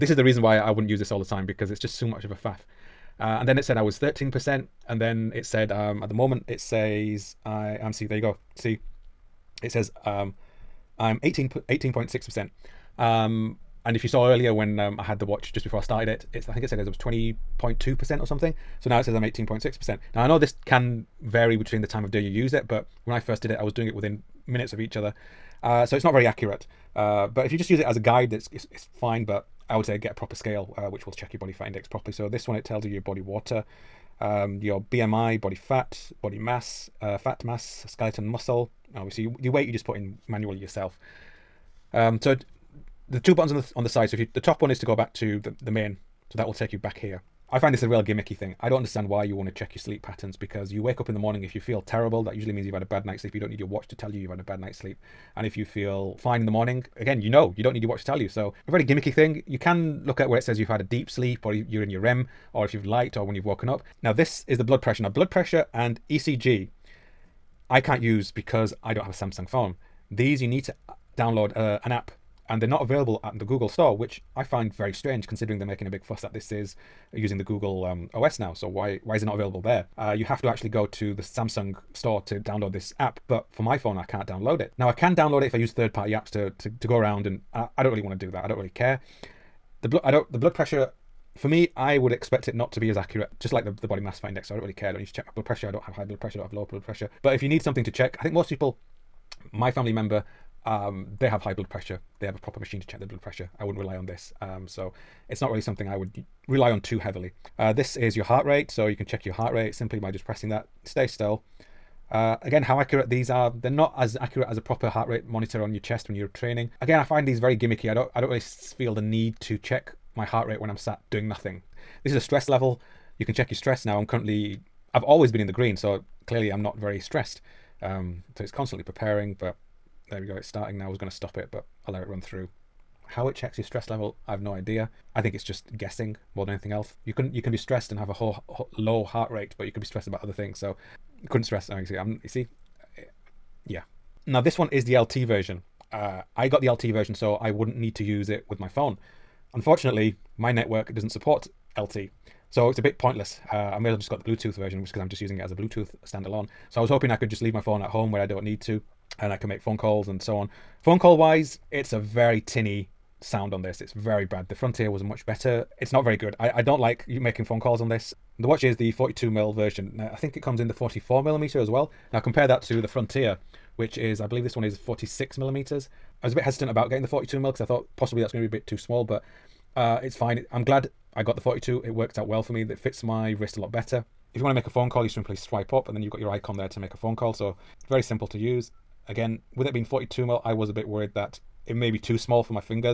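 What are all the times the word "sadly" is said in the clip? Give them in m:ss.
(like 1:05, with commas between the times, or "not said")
not said.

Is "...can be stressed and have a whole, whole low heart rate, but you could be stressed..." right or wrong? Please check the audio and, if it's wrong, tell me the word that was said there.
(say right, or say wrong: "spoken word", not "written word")
right.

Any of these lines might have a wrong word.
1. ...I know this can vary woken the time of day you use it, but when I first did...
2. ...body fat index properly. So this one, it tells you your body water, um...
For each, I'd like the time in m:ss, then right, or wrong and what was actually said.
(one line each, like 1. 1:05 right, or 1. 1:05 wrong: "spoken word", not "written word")
1. 0:20 wrong: "between", not "woken"
2. 0:31 right.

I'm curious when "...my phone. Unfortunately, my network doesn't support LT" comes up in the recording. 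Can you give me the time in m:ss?
2:28.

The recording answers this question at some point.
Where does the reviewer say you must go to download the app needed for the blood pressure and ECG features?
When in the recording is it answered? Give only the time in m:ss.
1:21.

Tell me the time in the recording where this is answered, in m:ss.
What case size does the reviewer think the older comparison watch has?
2:54.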